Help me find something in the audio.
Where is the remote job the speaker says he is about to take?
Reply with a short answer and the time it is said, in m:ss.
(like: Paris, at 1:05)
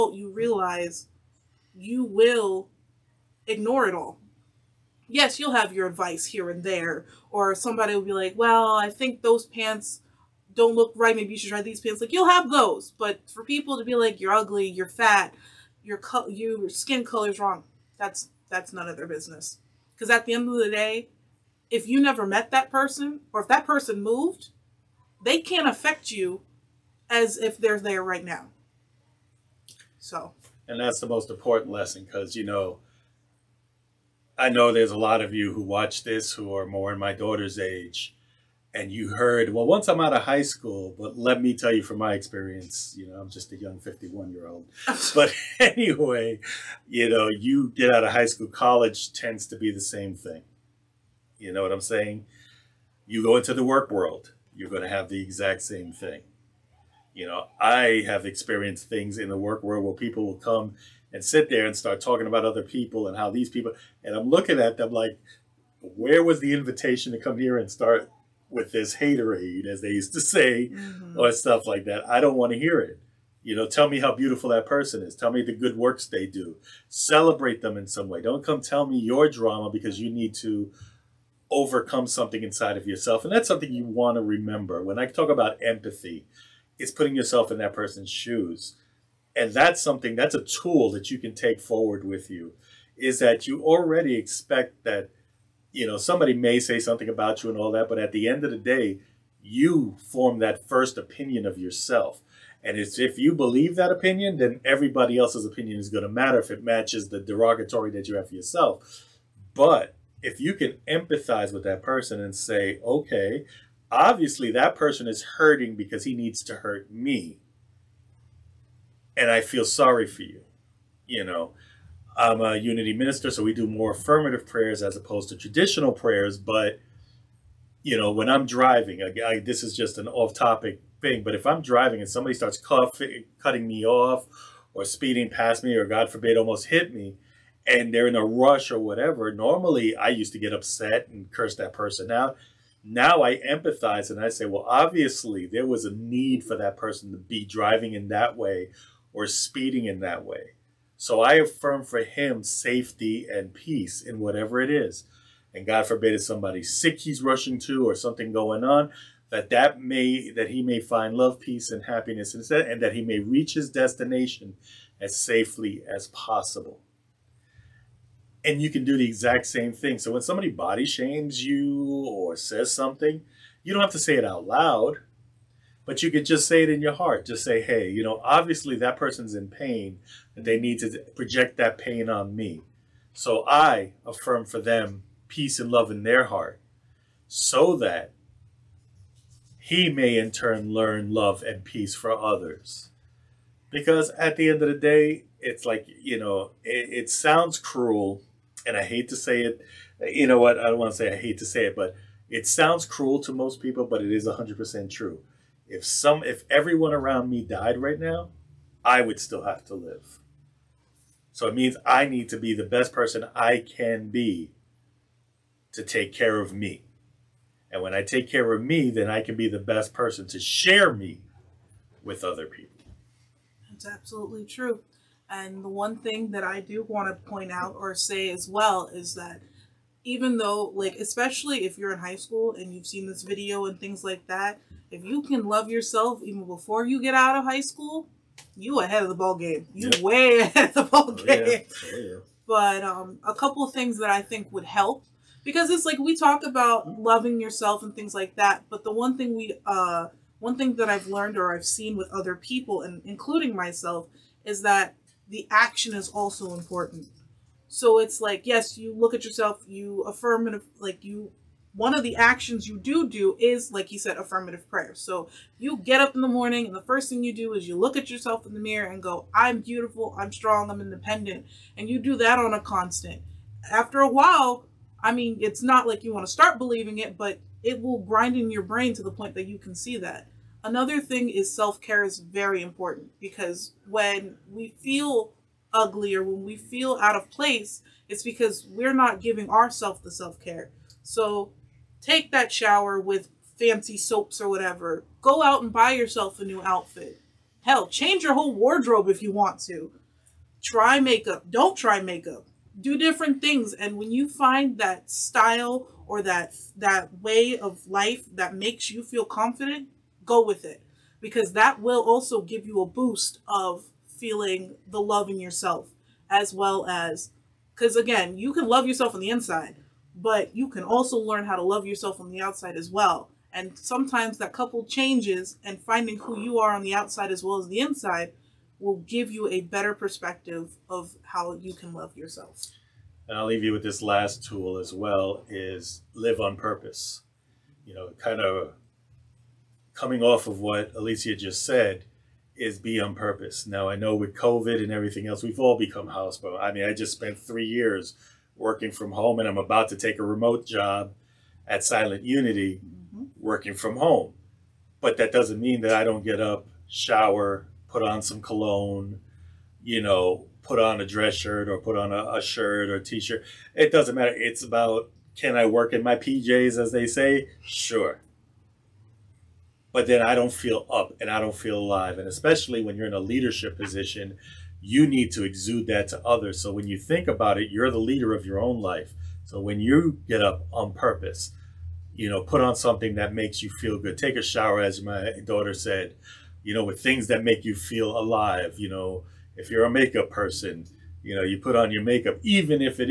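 Silent Unity, at 5:51.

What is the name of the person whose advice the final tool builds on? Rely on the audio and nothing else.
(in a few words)
Alicia.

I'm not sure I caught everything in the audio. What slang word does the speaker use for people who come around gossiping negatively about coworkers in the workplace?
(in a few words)
haterade.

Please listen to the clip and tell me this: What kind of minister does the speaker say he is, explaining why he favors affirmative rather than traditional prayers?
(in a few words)
Unity minister.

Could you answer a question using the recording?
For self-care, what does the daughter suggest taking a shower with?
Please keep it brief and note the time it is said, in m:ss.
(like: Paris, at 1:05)
fancy soaps, at 4:53.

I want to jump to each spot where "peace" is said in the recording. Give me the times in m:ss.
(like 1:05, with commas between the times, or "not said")
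2:33, 2:41, 3:05, 3:11.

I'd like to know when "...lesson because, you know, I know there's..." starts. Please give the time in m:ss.
0:31.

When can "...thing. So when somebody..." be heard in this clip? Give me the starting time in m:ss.
2:49.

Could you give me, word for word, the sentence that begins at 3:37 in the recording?
And when I take care of me, then I can be the best person to share me with other people.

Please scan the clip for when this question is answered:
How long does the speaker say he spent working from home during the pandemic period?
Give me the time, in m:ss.
5:47.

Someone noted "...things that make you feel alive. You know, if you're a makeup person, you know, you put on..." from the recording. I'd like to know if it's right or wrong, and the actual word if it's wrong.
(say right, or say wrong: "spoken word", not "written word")
right.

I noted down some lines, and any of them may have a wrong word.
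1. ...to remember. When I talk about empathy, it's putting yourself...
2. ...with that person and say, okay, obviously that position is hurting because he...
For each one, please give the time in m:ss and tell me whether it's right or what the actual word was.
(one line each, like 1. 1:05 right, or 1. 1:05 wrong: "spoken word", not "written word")
1. 1:24 right
2. 1:51 wrong: "person", not "position".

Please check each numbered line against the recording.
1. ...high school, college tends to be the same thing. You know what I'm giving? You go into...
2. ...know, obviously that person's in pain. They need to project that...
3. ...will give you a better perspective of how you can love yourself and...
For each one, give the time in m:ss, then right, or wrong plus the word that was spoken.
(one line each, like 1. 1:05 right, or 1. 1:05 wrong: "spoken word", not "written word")
1. 0:48 wrong: "saying", not "giving"
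2. 2:58 right
3. 5:28 right.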